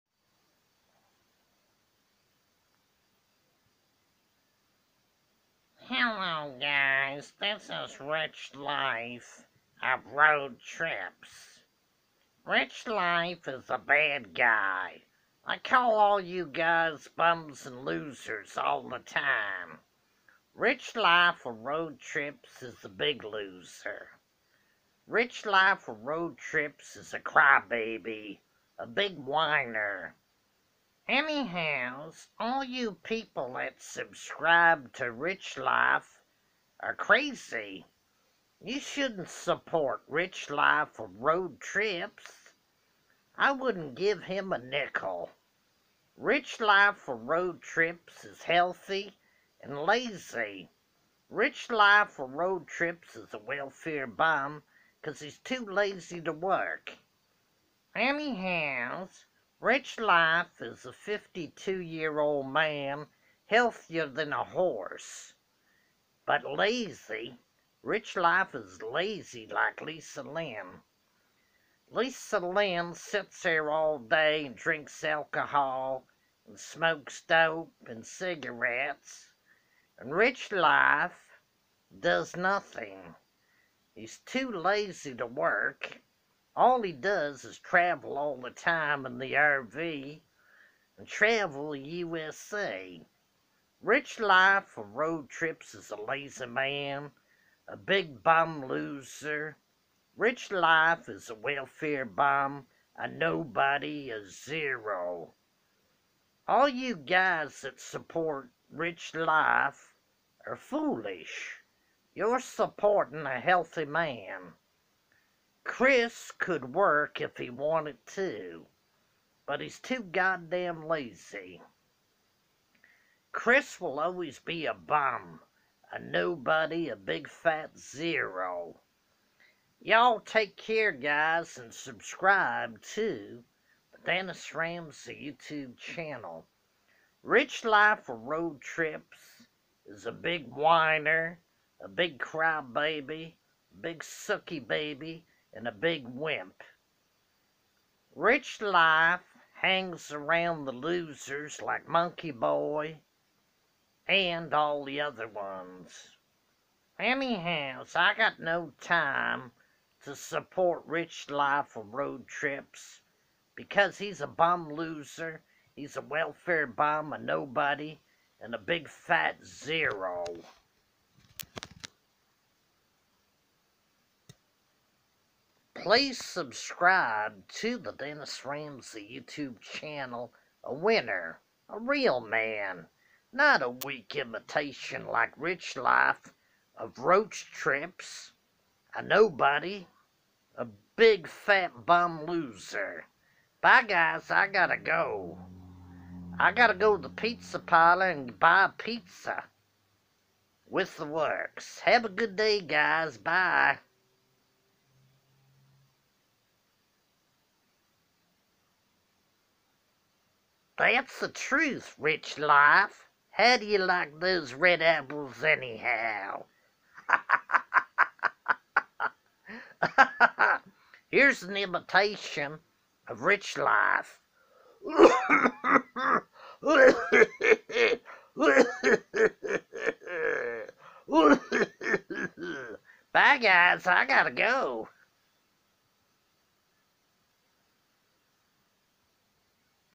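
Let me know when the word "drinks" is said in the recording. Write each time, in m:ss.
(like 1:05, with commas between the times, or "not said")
1:14.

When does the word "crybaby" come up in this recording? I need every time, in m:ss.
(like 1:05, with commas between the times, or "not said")
0:27, 2:22.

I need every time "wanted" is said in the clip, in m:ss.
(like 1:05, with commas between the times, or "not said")
1:57.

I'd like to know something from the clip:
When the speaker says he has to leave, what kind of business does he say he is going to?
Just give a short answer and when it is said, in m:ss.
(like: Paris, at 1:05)
Pizza parlor, at 3:17.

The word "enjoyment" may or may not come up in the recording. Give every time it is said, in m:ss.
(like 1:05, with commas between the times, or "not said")
not said.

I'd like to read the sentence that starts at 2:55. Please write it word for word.
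Please subscribe to the Dennis Ramsay YouTube channel, a winner, a real man.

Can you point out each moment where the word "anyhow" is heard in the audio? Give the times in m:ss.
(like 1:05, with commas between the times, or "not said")
0:31, 0:57, 2:36, 3:35.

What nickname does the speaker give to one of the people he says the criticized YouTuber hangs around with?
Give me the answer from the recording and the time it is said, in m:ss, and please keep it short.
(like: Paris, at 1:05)
Monkey Boy, at 2:31.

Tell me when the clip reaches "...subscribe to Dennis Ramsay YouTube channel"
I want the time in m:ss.
2:11.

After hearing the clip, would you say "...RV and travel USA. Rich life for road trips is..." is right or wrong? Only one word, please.
right.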